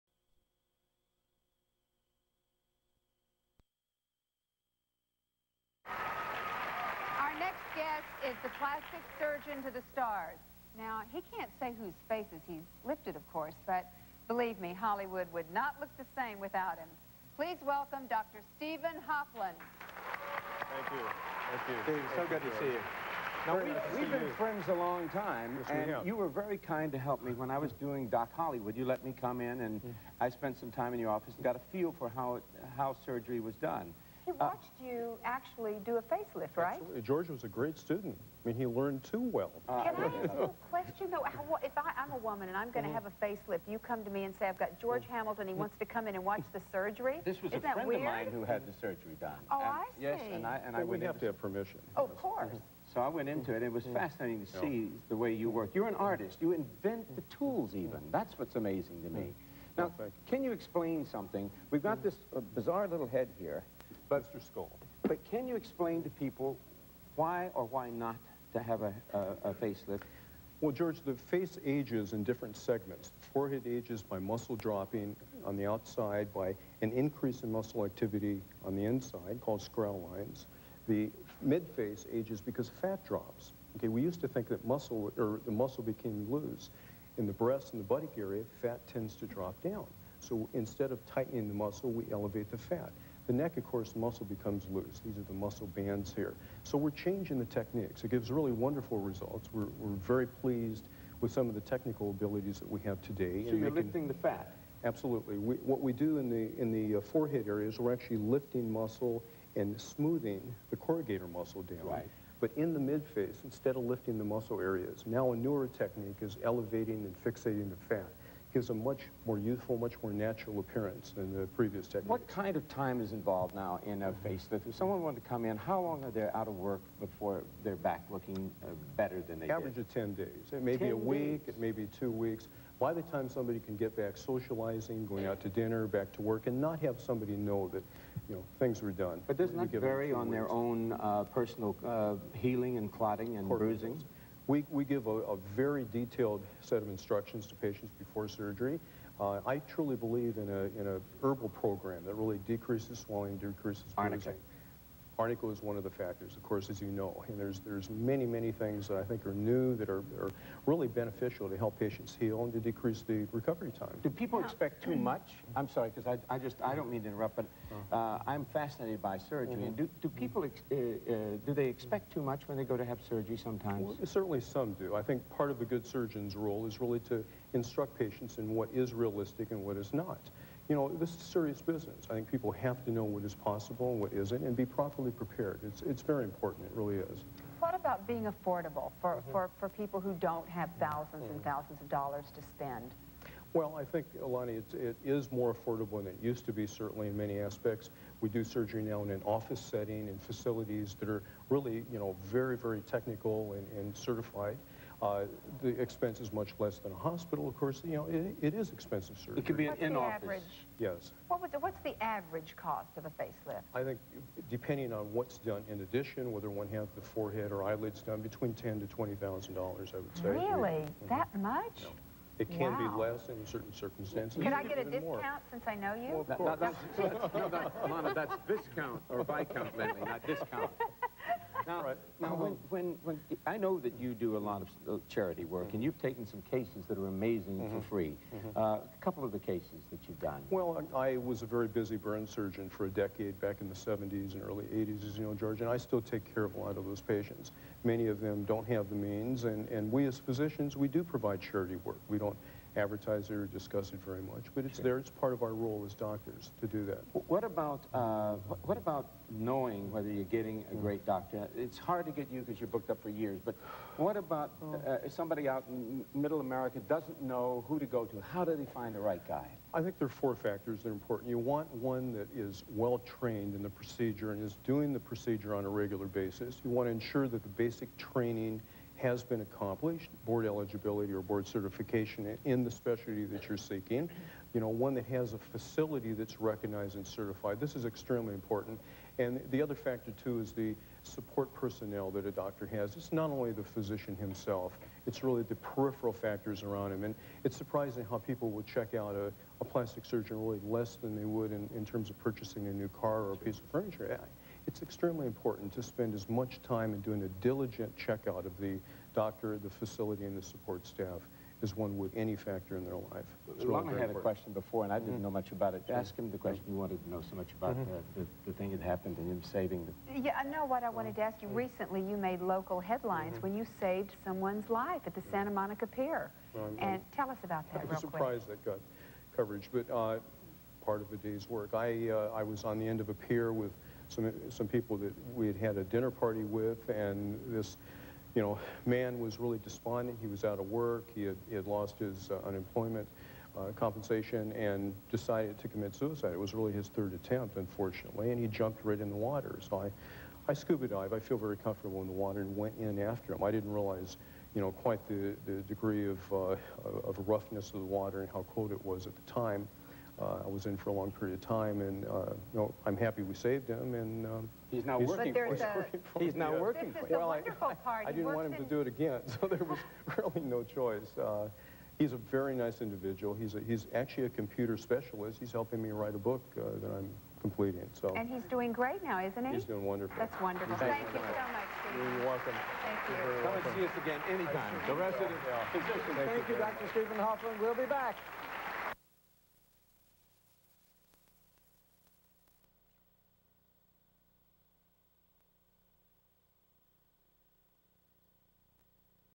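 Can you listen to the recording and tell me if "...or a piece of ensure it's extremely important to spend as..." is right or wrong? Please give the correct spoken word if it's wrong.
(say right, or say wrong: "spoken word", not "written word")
wrong: "furniture", not "ensure".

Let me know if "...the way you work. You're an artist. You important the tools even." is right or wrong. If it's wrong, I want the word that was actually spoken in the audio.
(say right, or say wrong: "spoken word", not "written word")
wrong: "invent", not "important".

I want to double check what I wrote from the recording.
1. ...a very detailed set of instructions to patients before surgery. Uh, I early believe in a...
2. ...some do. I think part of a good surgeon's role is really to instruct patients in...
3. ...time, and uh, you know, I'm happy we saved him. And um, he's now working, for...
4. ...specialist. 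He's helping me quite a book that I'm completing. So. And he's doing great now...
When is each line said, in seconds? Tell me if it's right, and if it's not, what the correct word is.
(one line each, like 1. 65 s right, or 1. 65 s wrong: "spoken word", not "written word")
1. 145 s wrong: "truly", not "early"
2. 174 s right
3. 361 s right
4. 374 s wrong: "write", not "quite".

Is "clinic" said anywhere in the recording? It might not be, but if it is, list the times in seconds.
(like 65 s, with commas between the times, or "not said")
not said.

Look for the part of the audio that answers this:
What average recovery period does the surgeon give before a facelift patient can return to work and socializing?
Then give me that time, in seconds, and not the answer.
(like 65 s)
129 s.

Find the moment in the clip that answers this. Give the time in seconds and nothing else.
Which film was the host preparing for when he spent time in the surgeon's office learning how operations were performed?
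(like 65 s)
28 s.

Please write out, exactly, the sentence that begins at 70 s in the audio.
Well, George, the face ages in different segments.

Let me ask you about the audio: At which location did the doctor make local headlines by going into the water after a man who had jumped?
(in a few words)
Santa Monica Pier.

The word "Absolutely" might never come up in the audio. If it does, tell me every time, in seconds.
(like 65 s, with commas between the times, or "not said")
36 s, 104 s.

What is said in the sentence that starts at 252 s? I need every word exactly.
We don't advertiser discuss it very much, but it's sure.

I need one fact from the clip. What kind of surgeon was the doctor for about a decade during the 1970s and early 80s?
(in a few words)
burn surgeon.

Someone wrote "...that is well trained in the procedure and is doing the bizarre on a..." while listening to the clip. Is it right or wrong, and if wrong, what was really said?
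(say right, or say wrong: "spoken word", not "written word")
wrong: "procedure", not "bizarre".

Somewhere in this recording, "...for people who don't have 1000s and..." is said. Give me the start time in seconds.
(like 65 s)
189 s.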